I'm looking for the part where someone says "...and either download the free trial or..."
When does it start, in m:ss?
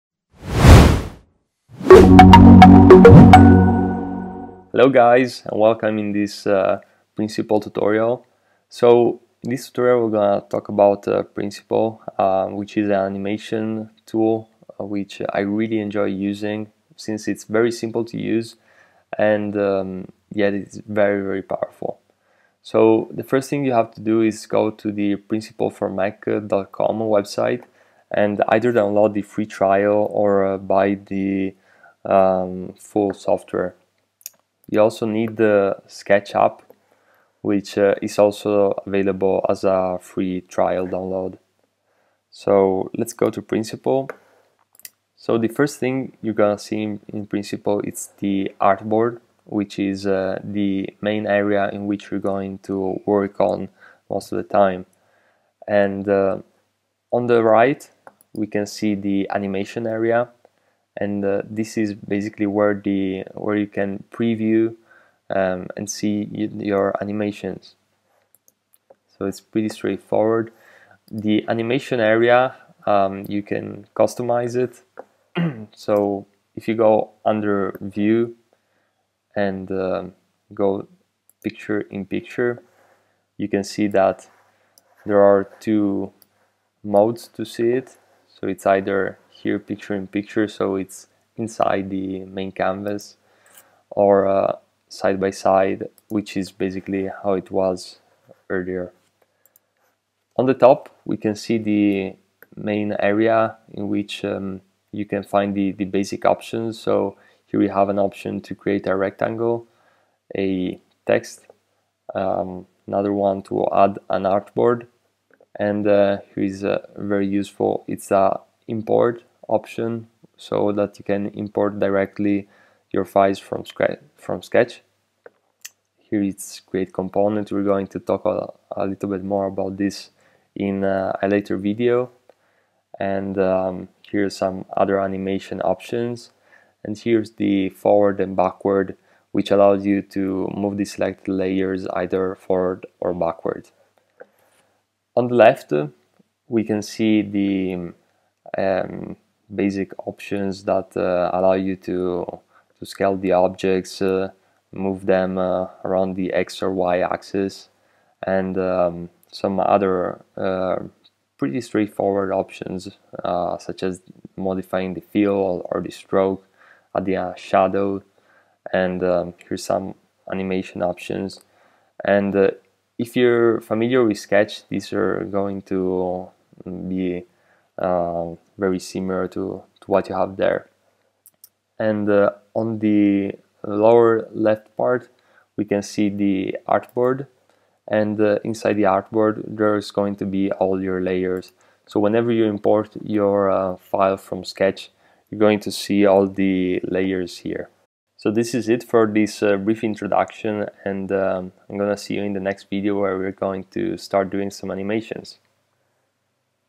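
0:28.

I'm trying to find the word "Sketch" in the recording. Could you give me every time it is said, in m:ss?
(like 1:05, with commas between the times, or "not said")
0:35, 2:04, 2:54, 3:14.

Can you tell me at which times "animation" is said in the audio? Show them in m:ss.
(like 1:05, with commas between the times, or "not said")
0:12, 0:59, 1:07, 1:11, 2:14, 2:50, 3:24.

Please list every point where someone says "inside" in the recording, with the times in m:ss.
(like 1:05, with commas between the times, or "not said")
1:31, 3:08.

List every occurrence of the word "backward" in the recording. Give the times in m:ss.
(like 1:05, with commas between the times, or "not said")
2:18, 2:23.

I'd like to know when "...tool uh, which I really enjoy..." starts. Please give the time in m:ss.
0:14.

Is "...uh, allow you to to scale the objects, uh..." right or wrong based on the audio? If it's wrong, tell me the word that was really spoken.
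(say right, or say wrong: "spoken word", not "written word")
right.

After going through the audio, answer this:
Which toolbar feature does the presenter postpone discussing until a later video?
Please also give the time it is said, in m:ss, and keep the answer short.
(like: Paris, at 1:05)
Create component, at 2:06.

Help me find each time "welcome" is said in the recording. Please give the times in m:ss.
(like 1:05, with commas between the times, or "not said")
0:05.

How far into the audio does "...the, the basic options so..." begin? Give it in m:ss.
1:45.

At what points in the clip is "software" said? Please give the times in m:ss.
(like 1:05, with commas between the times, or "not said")
0:33.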